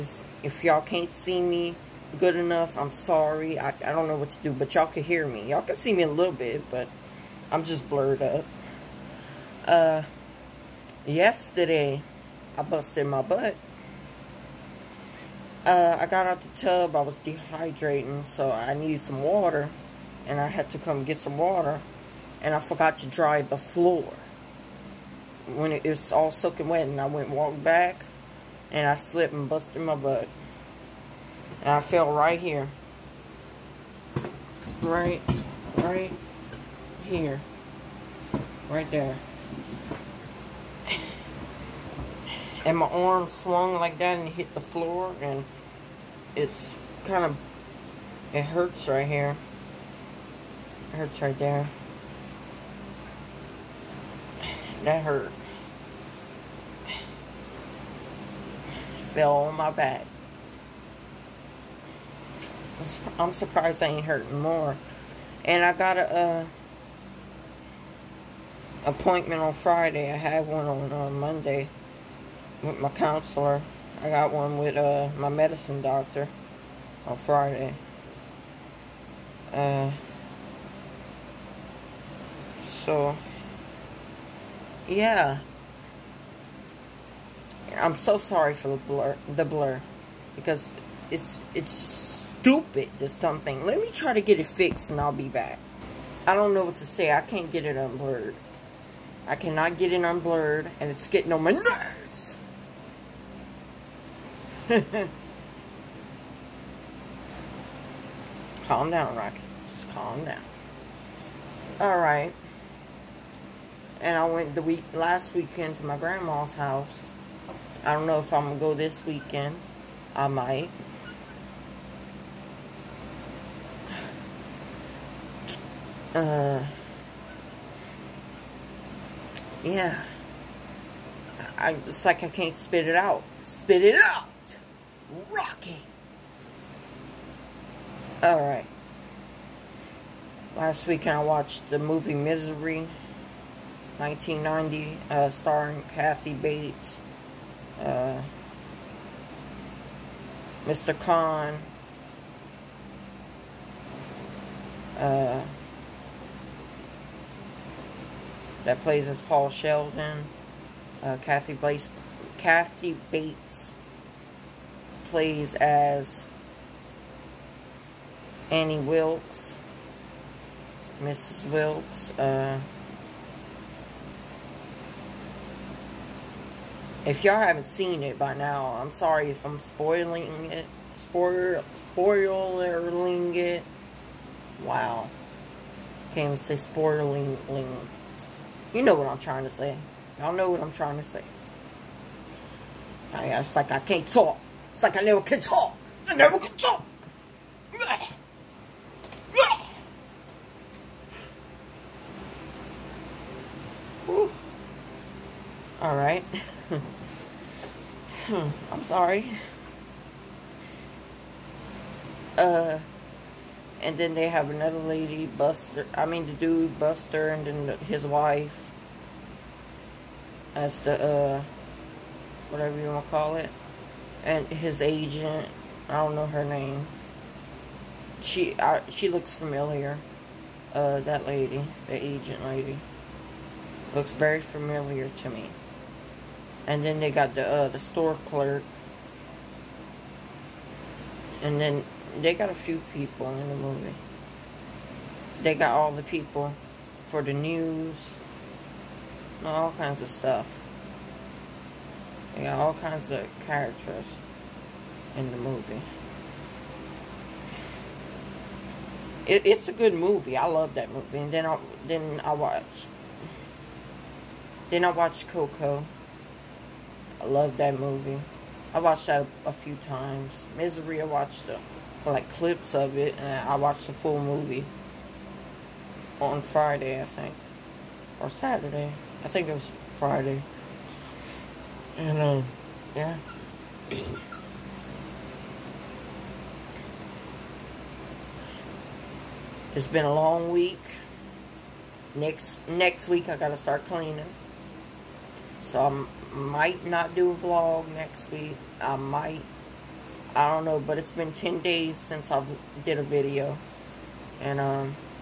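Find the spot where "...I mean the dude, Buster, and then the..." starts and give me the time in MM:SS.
03:35.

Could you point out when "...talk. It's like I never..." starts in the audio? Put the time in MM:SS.
03:14.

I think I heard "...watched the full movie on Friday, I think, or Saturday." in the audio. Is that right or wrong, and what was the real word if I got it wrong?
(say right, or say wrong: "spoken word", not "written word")
right.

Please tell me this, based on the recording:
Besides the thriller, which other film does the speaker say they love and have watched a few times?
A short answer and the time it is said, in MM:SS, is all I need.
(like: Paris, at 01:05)
Coco, at 04:25.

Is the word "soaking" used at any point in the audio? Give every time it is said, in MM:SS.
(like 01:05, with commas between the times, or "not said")
00:26.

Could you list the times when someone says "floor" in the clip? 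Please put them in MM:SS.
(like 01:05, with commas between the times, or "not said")
00:23, 00:44.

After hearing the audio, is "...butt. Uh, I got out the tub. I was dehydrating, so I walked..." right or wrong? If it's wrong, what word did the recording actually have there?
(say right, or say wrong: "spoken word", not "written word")
wrong: "needed", not "walked".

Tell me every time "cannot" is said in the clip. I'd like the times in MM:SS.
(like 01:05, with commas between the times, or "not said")
01:39.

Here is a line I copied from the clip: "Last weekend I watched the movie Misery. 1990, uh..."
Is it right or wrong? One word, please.
right.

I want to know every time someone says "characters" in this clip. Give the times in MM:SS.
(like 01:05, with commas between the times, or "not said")
04:13.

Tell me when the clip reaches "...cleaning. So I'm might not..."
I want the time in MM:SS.
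04:53.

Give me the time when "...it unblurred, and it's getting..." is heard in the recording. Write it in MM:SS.
01:39.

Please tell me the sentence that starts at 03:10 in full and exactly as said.
Y'all know what I'm trying to say.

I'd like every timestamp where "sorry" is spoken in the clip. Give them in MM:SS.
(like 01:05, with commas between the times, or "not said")
00:02, 01:28, 02:58, 03:28.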